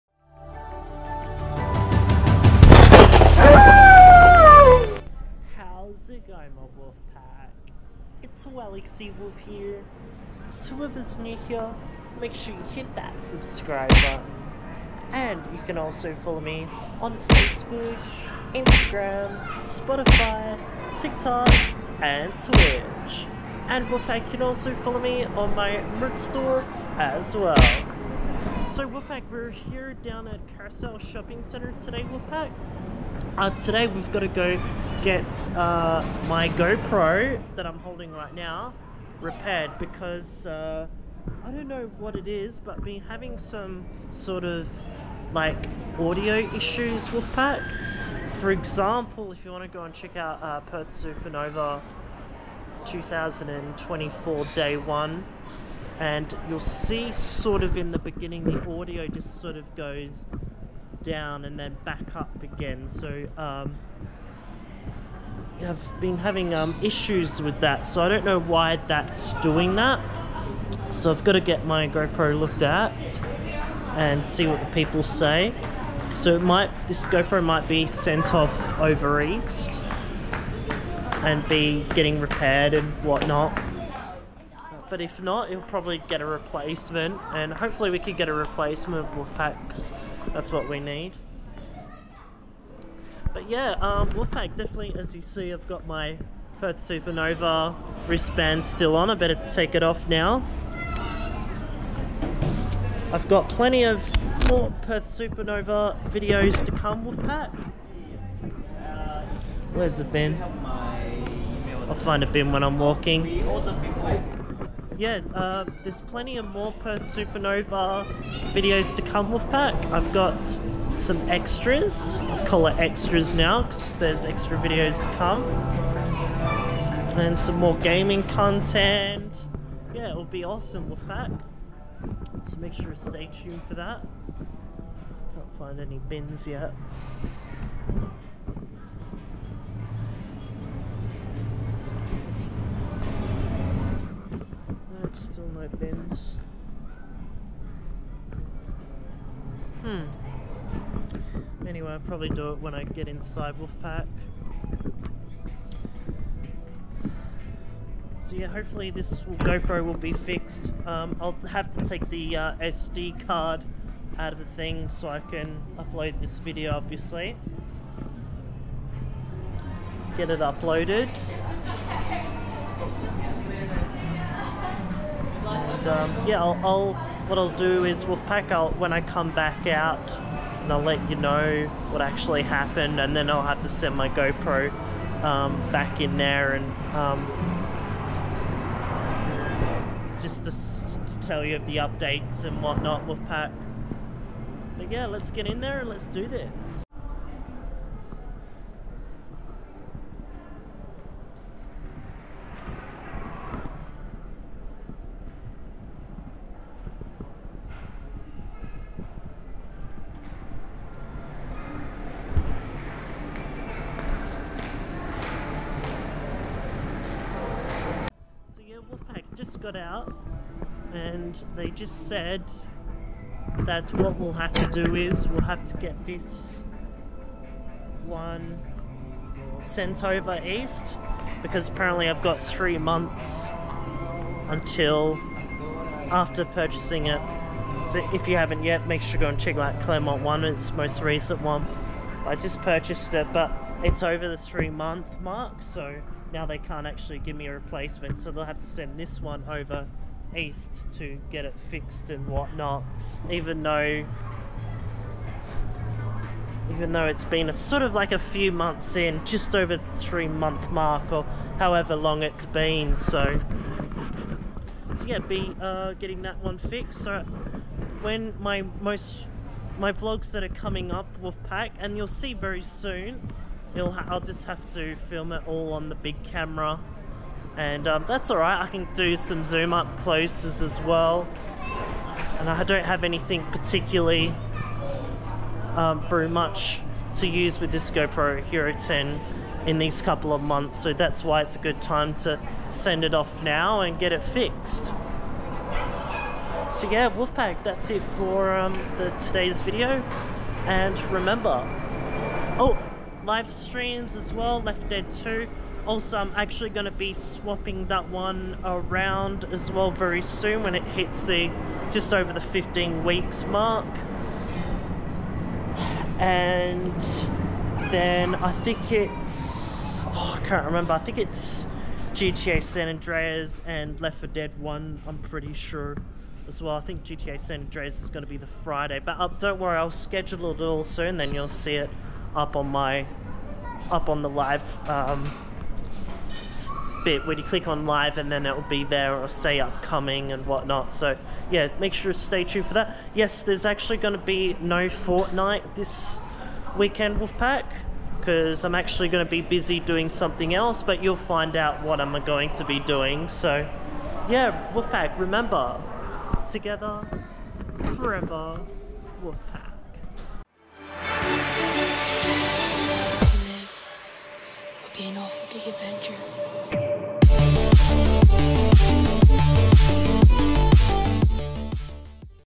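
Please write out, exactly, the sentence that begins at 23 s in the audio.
And Wolfpack can also follow me on my merch store as well.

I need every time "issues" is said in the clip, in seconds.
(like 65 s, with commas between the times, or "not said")
46 s, 66 s.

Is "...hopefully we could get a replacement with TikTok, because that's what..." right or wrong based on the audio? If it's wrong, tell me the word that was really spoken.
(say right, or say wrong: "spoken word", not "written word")
wrong: "Wolfpack", not "TikTok".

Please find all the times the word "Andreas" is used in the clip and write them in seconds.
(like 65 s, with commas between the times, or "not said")
322 s, 327 s.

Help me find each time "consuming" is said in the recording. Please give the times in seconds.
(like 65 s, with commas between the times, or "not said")
not said.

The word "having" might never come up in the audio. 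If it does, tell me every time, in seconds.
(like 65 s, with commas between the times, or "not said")
43 s, 66 s.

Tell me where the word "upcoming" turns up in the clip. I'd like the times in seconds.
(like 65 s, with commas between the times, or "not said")
339 s.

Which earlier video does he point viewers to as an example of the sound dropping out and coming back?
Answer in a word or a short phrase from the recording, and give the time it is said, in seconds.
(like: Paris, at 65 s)
Perth Supernova 2024 Day 1, at 50 s.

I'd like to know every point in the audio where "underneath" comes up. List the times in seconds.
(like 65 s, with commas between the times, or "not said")
not said.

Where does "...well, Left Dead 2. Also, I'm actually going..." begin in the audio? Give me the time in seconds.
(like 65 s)
304 s.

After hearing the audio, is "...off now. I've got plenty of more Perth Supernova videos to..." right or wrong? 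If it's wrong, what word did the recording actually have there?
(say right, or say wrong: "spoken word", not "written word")
right.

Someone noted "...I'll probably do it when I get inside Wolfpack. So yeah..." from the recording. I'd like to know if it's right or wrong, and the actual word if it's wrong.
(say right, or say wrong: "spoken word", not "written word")
right.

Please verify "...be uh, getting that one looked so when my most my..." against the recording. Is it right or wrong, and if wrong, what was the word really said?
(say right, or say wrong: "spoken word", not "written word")
wrong: "fixed", not "looked".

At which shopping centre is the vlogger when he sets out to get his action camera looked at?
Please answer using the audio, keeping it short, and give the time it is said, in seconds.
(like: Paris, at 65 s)
Carousel Shopping Centre, at 30 s.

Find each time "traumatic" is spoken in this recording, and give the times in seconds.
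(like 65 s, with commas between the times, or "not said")
not said.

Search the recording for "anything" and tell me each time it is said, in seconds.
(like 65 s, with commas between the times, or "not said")
283 s.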